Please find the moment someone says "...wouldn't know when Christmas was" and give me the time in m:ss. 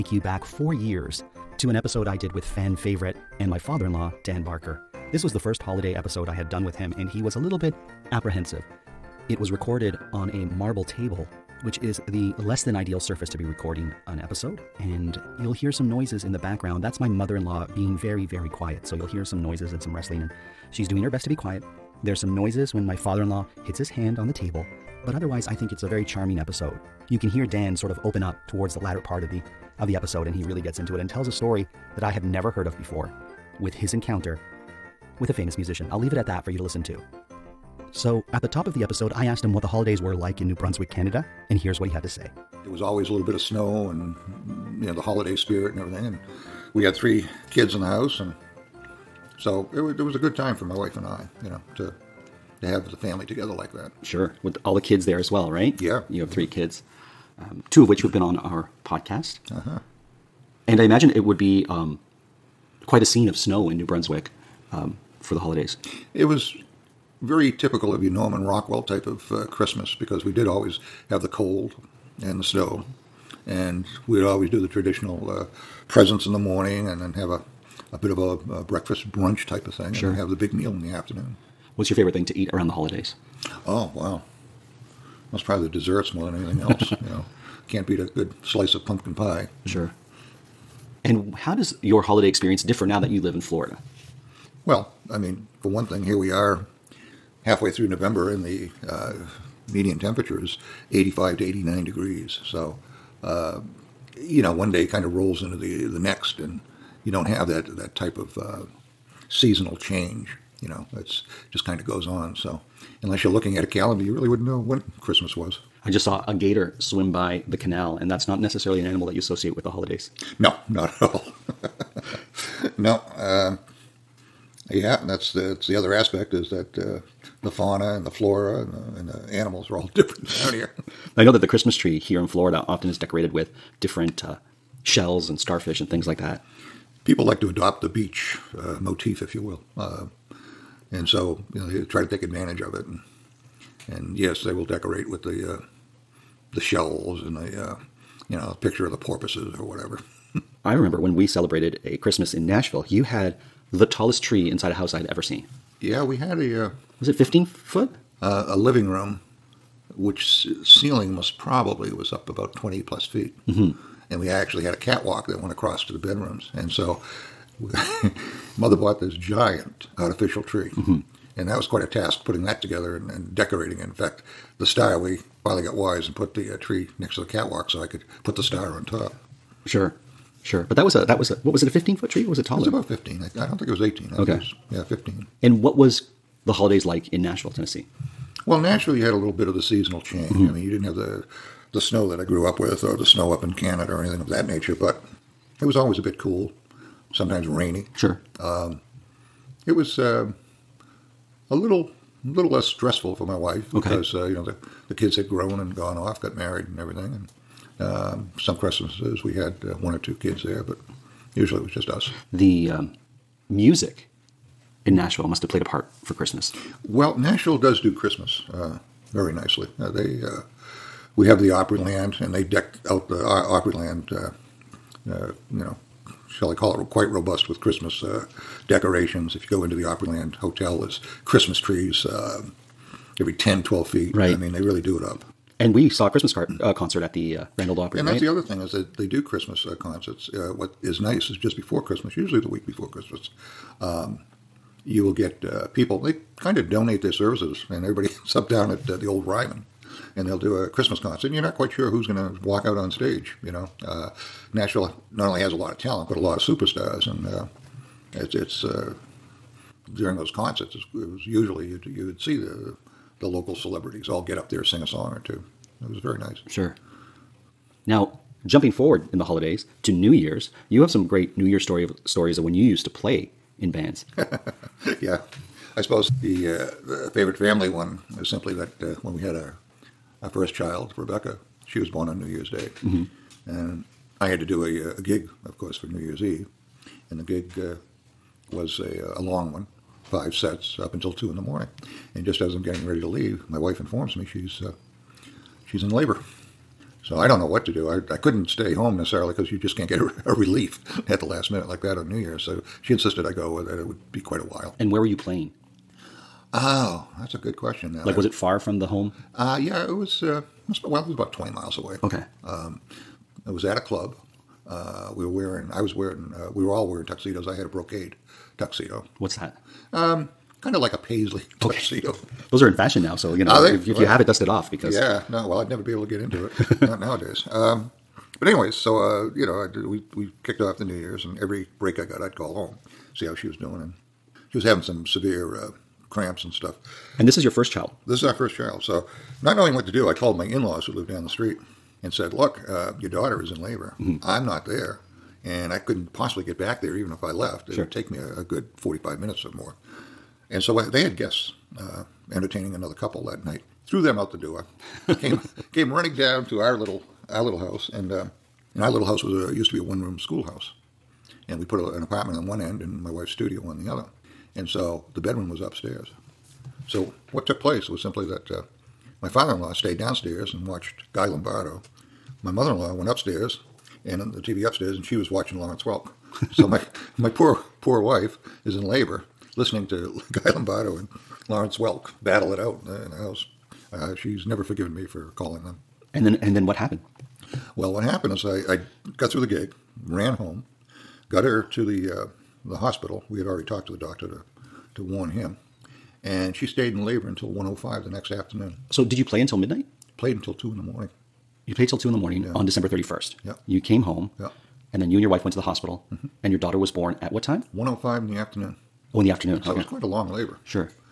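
1:54.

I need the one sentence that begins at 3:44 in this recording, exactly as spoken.
Uh, uh, you know, shall I call it quite robust with Christmas decorations.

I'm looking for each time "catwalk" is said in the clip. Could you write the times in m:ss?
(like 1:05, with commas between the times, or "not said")
2:44, 2:57.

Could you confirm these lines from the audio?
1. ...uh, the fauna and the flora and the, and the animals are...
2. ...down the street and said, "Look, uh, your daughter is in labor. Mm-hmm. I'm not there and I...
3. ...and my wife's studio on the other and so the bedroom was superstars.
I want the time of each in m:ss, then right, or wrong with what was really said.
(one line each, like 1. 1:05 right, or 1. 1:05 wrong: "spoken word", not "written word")
1. 2:06 right
2. 5:41 right
3. 6:02 wrong: "upstairs", not "superstars".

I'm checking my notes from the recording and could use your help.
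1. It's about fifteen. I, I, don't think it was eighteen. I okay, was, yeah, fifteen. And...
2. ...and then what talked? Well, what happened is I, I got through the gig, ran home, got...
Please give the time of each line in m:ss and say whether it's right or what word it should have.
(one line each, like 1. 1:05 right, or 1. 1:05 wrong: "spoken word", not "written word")
1. 3:02 right
2. 6:26 wrong: "happened", not "talked".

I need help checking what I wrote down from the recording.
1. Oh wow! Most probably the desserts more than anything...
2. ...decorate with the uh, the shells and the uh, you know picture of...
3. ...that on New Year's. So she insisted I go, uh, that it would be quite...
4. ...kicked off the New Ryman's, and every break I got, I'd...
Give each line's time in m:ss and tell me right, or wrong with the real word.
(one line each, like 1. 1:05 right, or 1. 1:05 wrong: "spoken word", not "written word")
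1. 1:23 right
2. 2:24 right
3. 5:01 right
4. 5:30 wrong: "Year", not "Ryman".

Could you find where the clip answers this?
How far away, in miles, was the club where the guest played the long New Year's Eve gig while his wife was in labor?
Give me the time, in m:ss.
5:11.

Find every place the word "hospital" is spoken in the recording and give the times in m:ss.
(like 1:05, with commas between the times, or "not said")
6:32, 6:45.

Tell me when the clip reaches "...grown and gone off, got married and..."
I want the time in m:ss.
3:25.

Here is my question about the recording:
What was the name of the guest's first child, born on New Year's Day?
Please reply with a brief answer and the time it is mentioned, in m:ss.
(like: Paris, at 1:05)
Rebecca, at 4:40.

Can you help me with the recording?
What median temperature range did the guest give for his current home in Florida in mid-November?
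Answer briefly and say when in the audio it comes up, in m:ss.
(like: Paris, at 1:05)
85 to 89 degrees, at 1:40.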